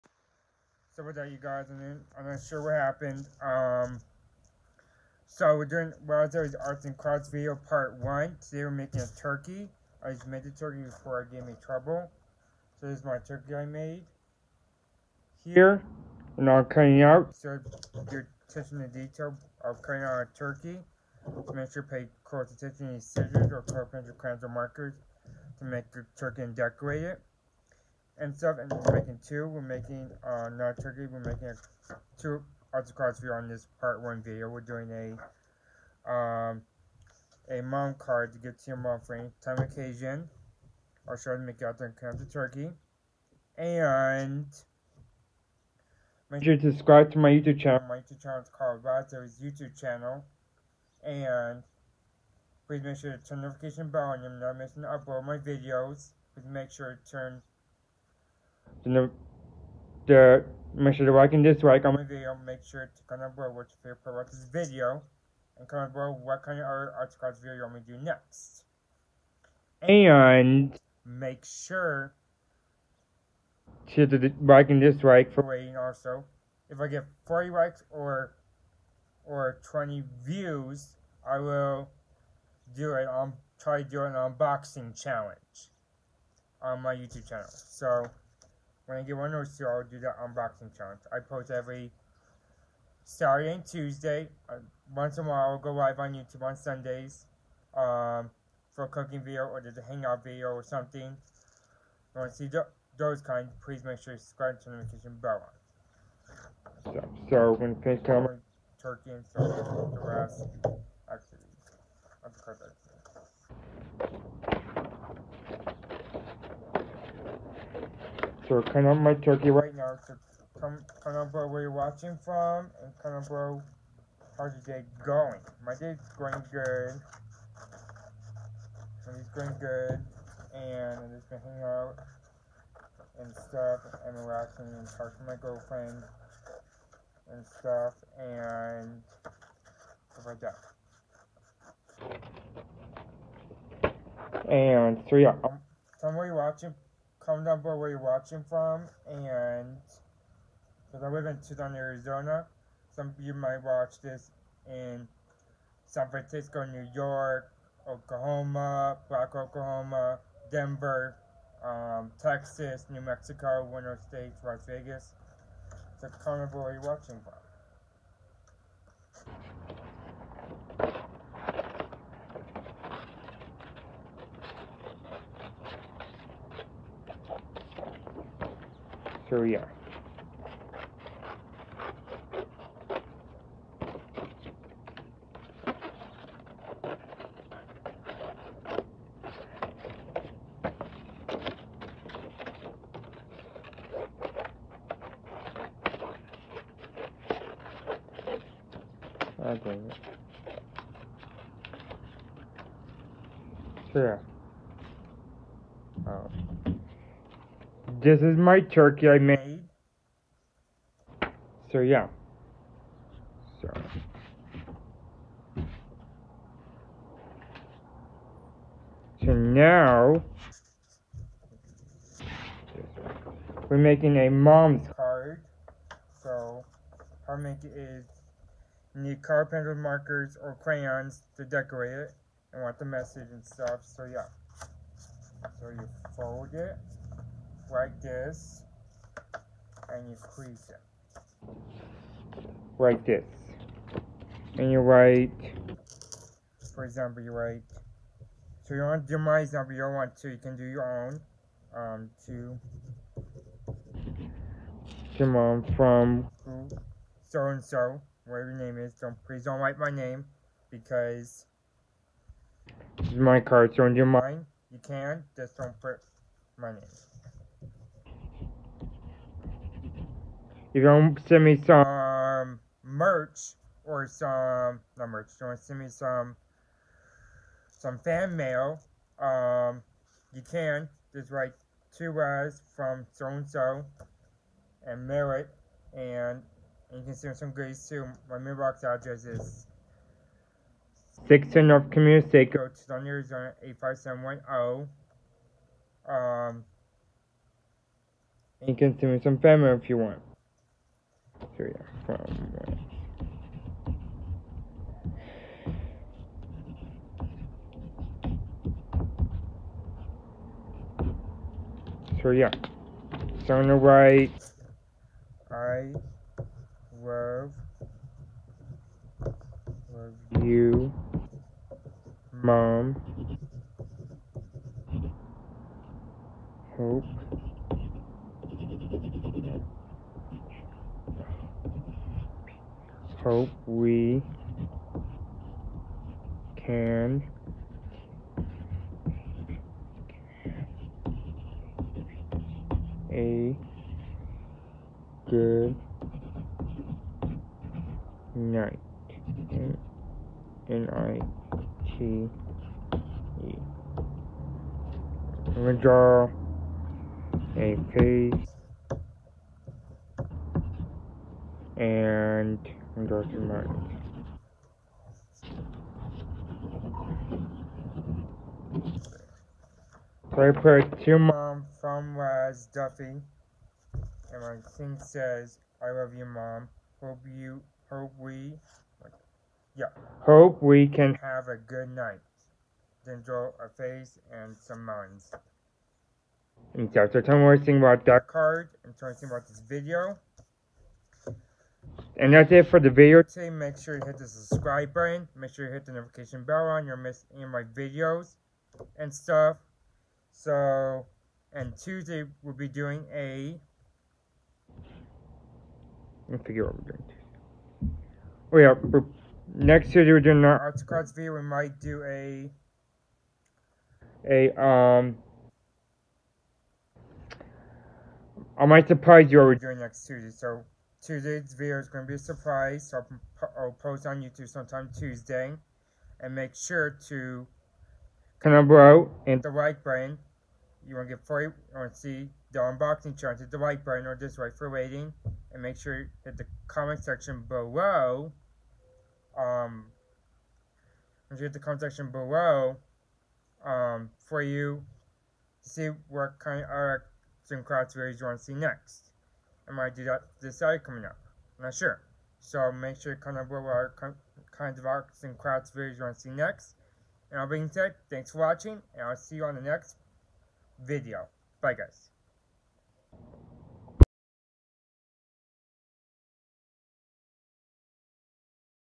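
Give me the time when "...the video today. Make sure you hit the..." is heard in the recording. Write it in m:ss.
6:32.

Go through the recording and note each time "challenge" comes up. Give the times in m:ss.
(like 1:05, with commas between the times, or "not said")
1:24, 1:30, 7:13.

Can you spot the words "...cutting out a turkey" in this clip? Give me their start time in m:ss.
0:19.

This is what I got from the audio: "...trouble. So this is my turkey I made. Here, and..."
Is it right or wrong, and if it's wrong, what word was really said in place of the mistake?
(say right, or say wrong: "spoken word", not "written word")
right.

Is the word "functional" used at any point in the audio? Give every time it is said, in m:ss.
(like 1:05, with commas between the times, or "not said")
not said.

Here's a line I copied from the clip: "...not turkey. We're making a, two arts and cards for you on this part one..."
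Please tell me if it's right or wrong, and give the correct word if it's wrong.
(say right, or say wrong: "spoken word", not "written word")
right.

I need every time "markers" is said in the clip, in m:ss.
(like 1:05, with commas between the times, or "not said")
0:24, 3:49.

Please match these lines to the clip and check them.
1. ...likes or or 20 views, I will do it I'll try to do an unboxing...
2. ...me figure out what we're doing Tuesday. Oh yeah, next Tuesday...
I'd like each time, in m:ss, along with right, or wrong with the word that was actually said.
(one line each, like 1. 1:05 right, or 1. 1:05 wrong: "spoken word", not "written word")
1. 1:17 right
2. 6:46 right.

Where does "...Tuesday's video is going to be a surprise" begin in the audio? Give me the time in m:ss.
7:01.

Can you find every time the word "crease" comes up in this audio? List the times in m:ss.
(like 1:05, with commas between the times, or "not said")
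4:00.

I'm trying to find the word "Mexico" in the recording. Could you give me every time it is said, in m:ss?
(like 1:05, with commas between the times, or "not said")
2:43.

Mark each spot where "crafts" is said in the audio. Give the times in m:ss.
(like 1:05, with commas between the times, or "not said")
0:06, 7:27, 7:35.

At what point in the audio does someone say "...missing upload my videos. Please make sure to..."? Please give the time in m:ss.
0:54.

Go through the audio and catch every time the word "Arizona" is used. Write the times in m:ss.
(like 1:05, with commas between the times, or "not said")
2:31, 4:53.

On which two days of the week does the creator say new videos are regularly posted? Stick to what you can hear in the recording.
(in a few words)
Saturday and Tuesday.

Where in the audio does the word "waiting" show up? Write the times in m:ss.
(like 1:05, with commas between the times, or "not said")
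1:15, 7:14.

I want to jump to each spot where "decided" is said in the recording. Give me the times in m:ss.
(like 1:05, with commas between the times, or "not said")
7:30.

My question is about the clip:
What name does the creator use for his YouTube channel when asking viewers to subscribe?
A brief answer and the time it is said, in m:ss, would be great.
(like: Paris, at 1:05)
Razo's YouTube channel, at 0:48.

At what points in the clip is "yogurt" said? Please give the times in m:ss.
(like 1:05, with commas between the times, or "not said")
not said.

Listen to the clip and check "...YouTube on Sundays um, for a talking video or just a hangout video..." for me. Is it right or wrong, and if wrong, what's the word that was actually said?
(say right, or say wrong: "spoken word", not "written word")
wrong: "cooking", not "talking".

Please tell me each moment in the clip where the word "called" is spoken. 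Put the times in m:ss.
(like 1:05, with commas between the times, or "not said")
0:48.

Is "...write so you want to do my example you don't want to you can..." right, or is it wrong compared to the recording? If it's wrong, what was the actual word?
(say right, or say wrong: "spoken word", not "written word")
right.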